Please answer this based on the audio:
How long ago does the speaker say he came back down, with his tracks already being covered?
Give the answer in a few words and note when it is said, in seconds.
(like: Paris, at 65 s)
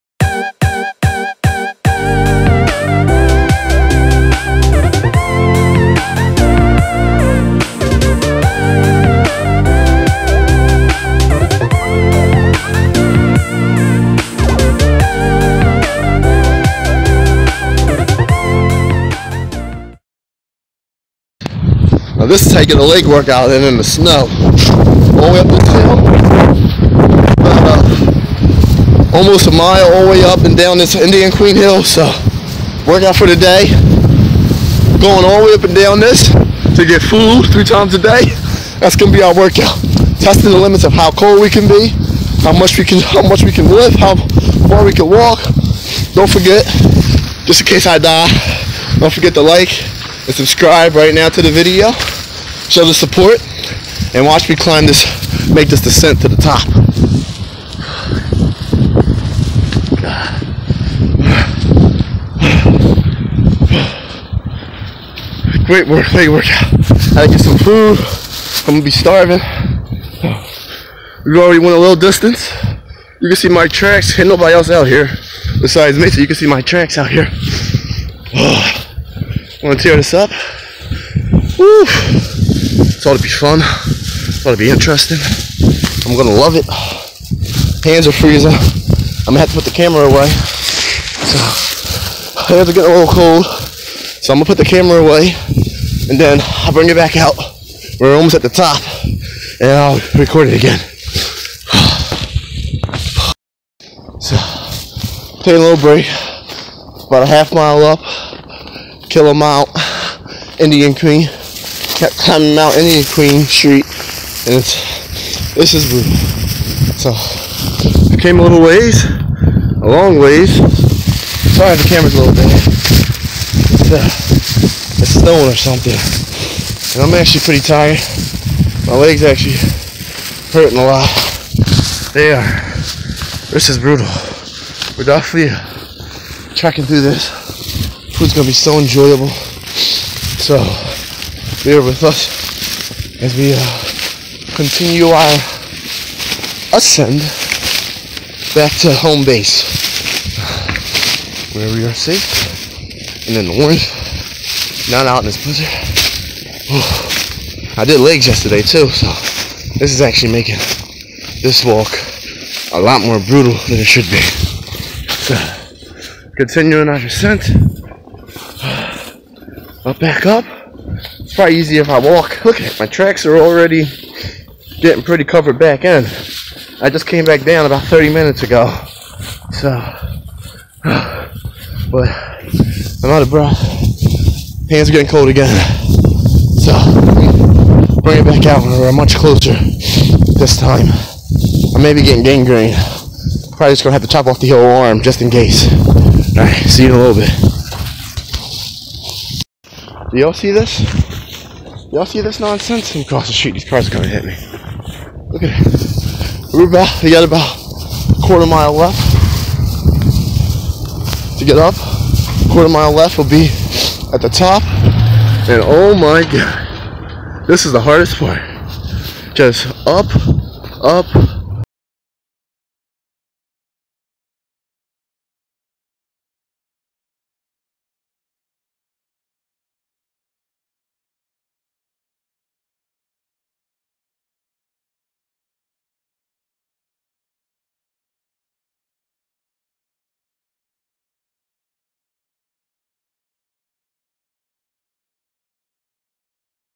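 30 minutes, at 177 s.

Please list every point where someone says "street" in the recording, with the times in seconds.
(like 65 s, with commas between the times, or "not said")
113 s, 203 s.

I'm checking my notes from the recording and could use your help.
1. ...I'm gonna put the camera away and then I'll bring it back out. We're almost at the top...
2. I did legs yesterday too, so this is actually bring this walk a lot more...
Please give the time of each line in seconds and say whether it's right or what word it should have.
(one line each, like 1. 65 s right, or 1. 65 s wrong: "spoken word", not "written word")
1. 94 s right
2. 157 s wrong: "making", not "bring".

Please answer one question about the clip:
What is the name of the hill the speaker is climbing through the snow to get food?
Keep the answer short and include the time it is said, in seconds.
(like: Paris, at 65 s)
Indian Queen Hill, at 30 s.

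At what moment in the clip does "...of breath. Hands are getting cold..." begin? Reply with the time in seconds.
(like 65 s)
183 s.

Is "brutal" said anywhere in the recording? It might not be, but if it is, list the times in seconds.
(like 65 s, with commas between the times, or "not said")
115 s, 133 s, 163 s.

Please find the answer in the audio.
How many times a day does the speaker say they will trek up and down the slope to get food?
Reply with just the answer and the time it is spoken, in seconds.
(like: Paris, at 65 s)
3, at 37 s.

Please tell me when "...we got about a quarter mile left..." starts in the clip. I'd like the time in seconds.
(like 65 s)
207 s.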